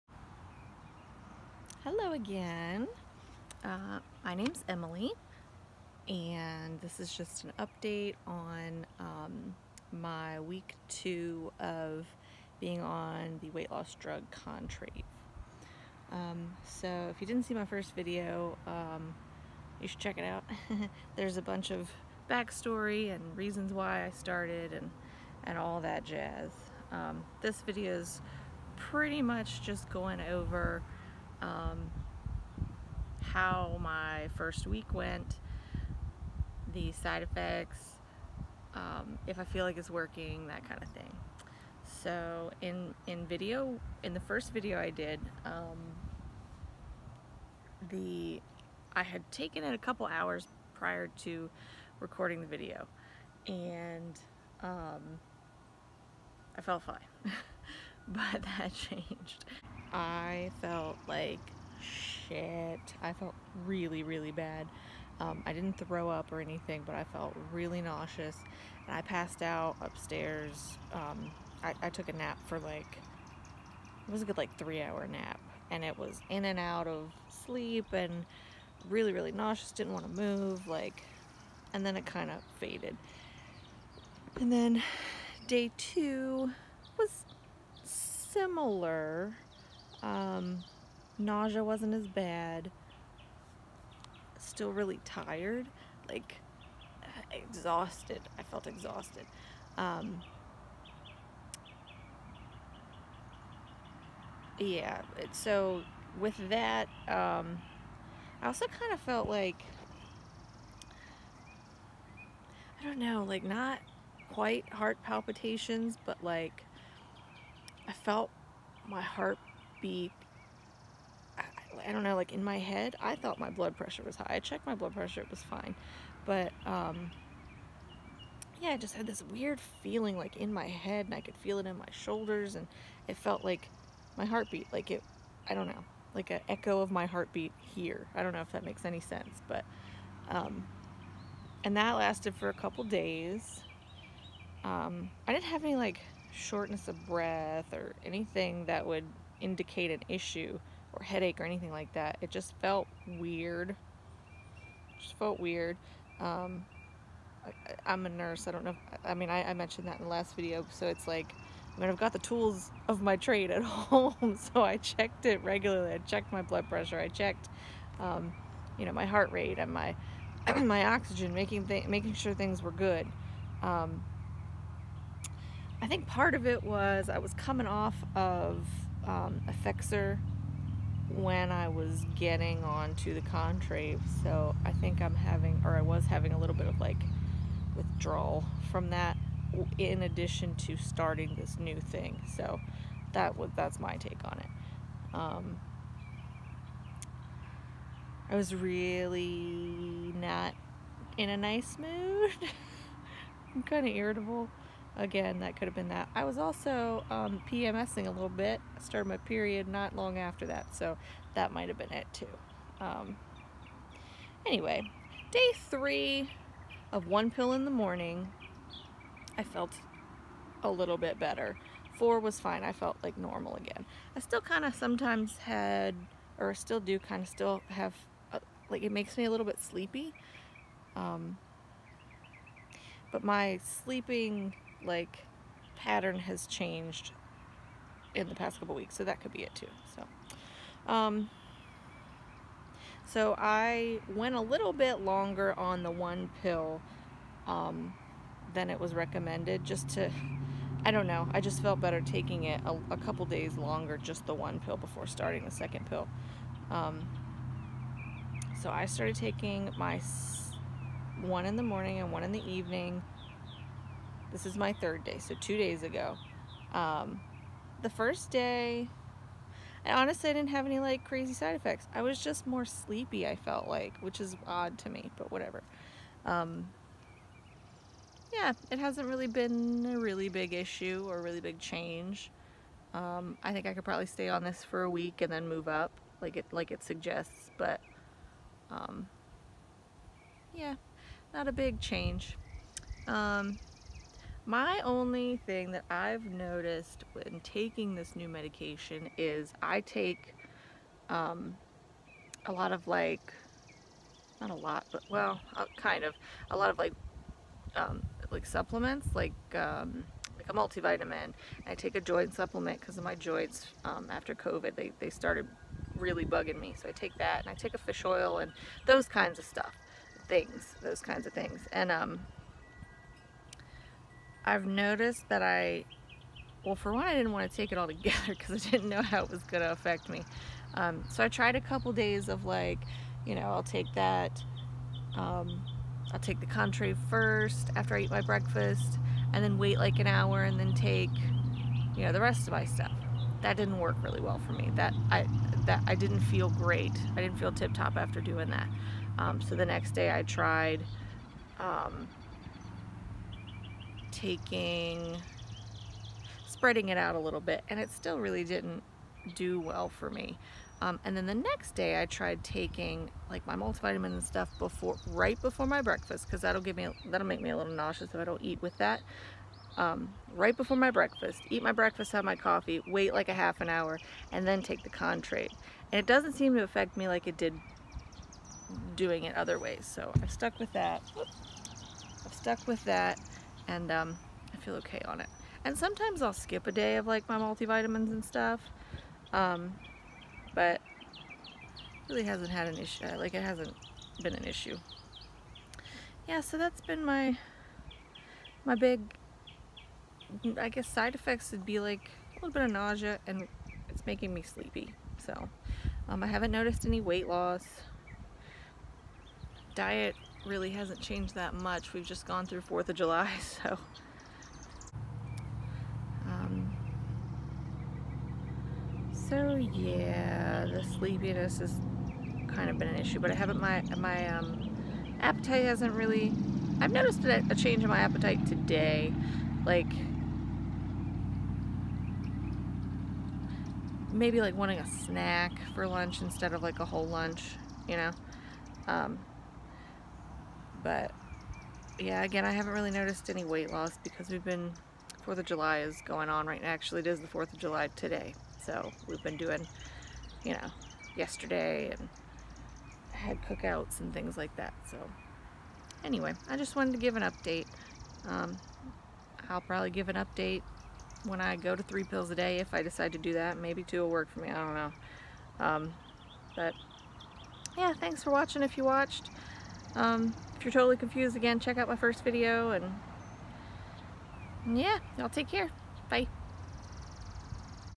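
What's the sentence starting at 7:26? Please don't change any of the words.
Actually, it is the 4th of July today.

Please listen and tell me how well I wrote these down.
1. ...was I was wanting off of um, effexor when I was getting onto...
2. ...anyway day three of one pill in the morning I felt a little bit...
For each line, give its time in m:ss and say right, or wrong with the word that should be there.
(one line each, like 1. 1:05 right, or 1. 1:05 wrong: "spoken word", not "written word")
1. 2:56 wrong: "coming", not "wanting"
2. 3:34 right.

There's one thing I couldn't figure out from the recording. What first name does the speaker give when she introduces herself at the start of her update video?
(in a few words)
Emily.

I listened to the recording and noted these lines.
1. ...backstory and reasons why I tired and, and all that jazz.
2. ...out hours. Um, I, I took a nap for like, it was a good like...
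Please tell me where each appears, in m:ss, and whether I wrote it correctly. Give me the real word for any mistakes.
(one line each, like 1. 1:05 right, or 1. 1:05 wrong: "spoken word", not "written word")
1. 0:22 wrong: "started", not "tired"
2. 1:09 wrong: "upstairs", not "hours".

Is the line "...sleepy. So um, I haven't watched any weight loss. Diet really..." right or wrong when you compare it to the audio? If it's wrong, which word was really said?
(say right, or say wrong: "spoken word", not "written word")
wrong: "noticed", not "watched".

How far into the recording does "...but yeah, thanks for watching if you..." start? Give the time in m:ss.
7:46.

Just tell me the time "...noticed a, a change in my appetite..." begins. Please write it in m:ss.
7:06.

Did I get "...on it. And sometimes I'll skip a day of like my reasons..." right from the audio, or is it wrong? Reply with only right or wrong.
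wrong.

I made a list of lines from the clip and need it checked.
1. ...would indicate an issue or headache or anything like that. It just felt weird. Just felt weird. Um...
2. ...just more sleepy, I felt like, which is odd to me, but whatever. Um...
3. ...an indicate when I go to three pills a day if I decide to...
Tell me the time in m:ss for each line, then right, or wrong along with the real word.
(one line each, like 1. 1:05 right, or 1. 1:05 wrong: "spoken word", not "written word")
1. 2:28 right
2. 4:32 right
3. 7:40 wrong: "update", not "indicate".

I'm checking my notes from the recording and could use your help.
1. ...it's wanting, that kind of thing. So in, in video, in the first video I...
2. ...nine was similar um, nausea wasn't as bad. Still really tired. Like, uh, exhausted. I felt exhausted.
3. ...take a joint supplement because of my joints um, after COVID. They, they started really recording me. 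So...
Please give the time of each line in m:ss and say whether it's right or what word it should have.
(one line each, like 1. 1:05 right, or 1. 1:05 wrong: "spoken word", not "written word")
1. 0:39 wrong: "working", not "wanting"
2. 1:25 wrong: "two", not "nine"
3. 5:11 wrong: "bugging", not "recording".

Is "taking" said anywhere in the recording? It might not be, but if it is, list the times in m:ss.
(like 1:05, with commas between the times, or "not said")
4:12, 4:19, 4:57, 5:54, 6:02.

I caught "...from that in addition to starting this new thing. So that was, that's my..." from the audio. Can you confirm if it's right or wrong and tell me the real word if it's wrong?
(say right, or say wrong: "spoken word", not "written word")
right.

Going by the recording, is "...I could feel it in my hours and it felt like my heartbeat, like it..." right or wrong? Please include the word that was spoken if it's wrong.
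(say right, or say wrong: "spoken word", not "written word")
wrong: "shoulders", not "hours".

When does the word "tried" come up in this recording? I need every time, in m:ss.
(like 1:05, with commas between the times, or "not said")
5:31, 5:50, 6:02.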